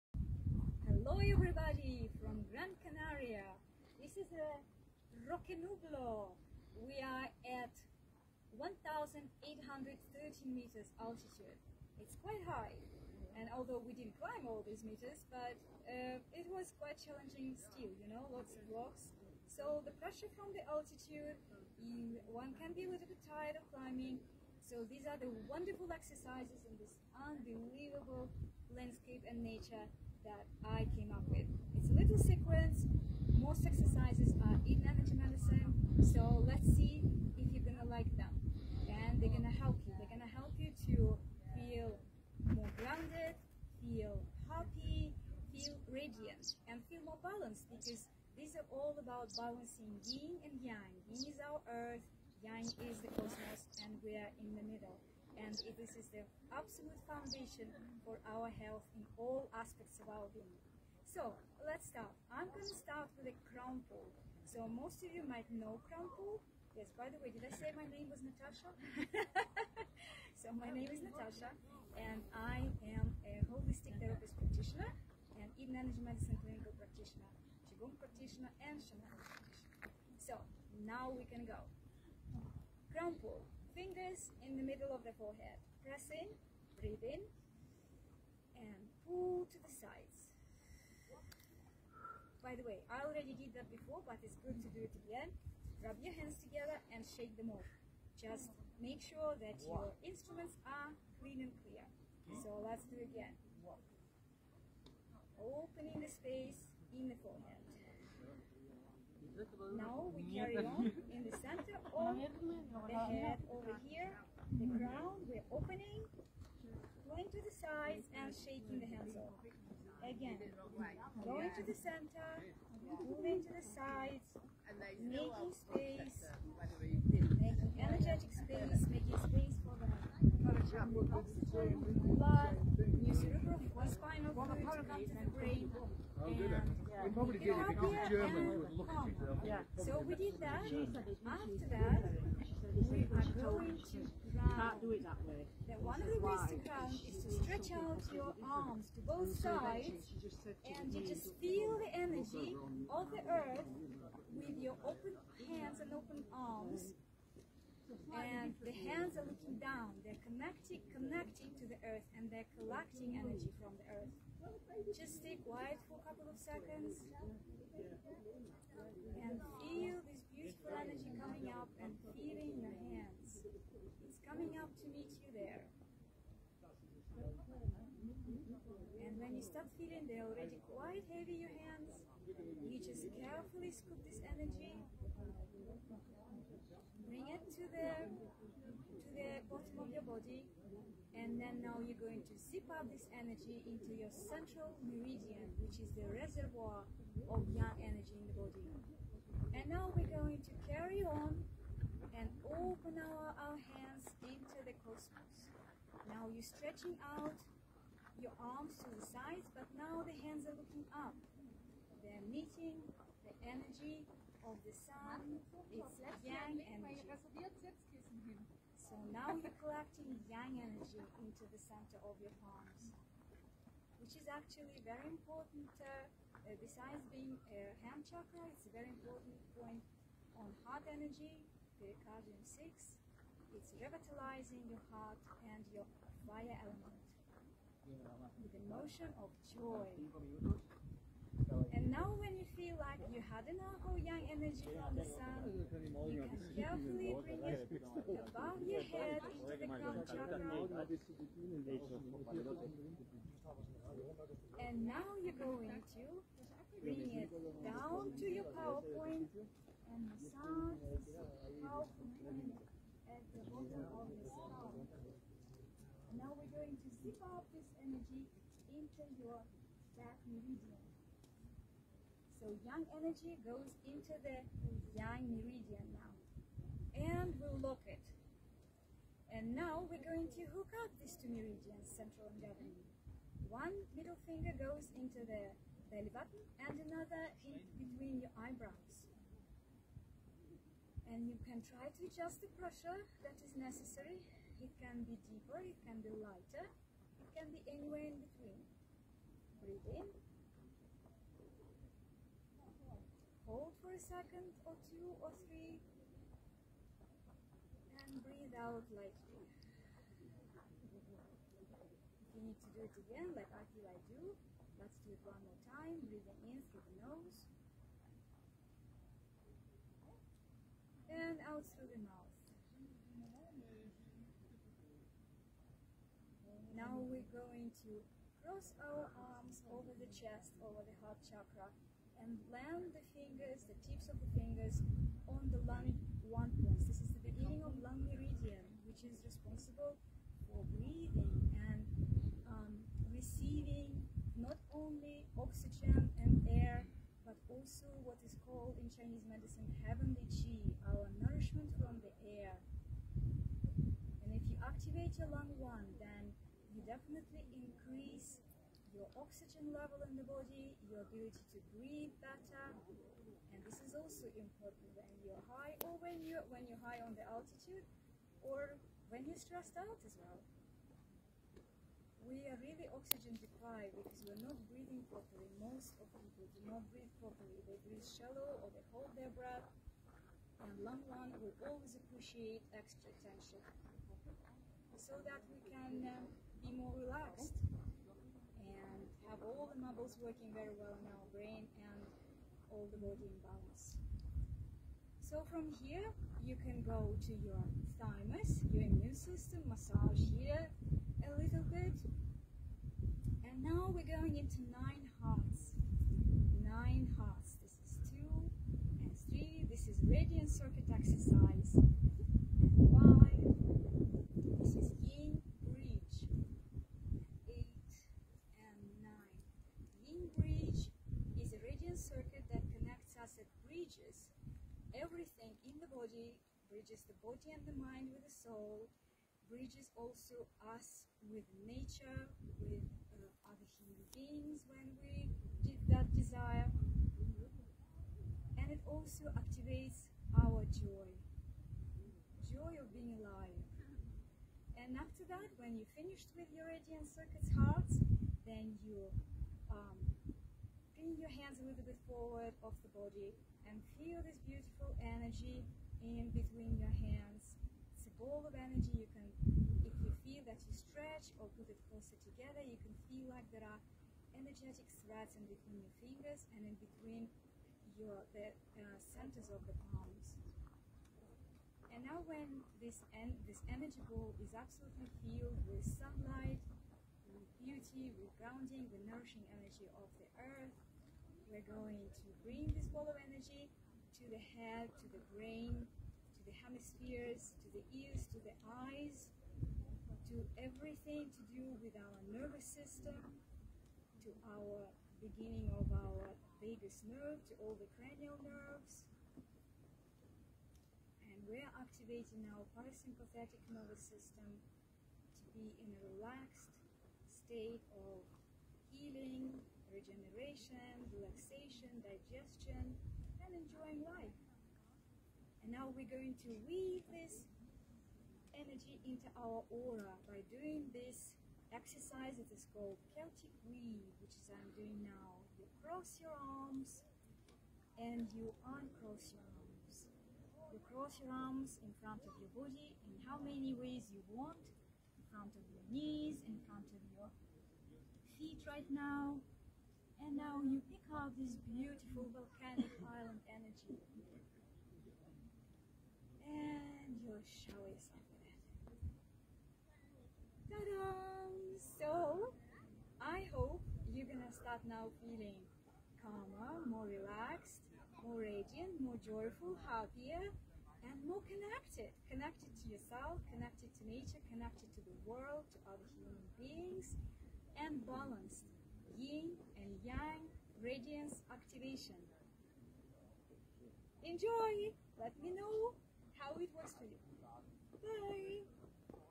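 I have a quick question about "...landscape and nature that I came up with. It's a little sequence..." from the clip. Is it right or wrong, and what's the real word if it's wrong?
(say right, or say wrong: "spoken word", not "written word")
right.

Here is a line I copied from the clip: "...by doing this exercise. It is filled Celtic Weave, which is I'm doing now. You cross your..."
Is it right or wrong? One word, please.
wrong.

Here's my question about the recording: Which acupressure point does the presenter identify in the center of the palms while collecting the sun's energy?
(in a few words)
Pericardium 6.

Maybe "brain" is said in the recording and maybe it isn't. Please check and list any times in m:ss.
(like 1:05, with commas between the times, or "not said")
2:15, 6:31, 8:05.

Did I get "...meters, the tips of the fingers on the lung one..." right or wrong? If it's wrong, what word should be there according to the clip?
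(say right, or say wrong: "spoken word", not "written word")
wrong: "fingers", not "meters".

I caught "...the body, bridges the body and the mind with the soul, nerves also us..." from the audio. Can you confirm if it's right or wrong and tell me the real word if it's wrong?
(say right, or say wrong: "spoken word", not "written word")
wrong: "bridges", not "nerves".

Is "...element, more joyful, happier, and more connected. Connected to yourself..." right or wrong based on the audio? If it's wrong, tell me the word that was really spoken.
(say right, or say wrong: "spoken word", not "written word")
wrong: "radiant", not "element".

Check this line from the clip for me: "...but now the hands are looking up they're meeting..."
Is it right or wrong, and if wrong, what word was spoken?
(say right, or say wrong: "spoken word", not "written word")
right.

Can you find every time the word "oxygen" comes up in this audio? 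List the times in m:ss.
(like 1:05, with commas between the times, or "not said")
5:45, 5:59, 6:12.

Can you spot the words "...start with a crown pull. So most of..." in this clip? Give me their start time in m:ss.
1:02.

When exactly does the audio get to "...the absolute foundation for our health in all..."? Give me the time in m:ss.
0:56.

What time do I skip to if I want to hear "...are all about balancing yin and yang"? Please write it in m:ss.
0:48.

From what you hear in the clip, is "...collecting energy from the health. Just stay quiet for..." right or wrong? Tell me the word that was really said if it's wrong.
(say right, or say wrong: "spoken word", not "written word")
wrong: "earth", not "health".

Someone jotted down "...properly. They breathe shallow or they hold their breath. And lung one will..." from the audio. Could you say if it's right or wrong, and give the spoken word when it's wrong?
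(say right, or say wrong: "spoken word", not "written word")
right.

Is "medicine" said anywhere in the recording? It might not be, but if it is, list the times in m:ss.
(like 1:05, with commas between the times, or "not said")
0:35, 1:15, 5:49.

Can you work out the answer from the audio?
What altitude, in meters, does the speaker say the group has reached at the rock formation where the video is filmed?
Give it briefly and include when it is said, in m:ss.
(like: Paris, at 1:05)
1,830 meters, at 0:08.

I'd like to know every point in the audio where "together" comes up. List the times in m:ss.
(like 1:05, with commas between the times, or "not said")
1:36, 7:42.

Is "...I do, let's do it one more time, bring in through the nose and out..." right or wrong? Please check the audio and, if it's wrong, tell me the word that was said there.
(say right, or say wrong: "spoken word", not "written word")
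wrong: "breathing", not "bring".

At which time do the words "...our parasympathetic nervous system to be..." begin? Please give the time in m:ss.
8:22.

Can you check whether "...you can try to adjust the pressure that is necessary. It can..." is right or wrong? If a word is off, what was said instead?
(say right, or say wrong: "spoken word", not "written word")
right.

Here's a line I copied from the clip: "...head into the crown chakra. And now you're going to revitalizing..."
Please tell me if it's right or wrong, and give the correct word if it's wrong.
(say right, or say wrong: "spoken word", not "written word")
wrong: "bring", not "revitalizing".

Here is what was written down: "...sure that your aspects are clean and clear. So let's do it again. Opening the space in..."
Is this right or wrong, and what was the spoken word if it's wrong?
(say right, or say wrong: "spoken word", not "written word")
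wrong: "instruments", not "aspects".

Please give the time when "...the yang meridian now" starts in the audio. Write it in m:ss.
4:34.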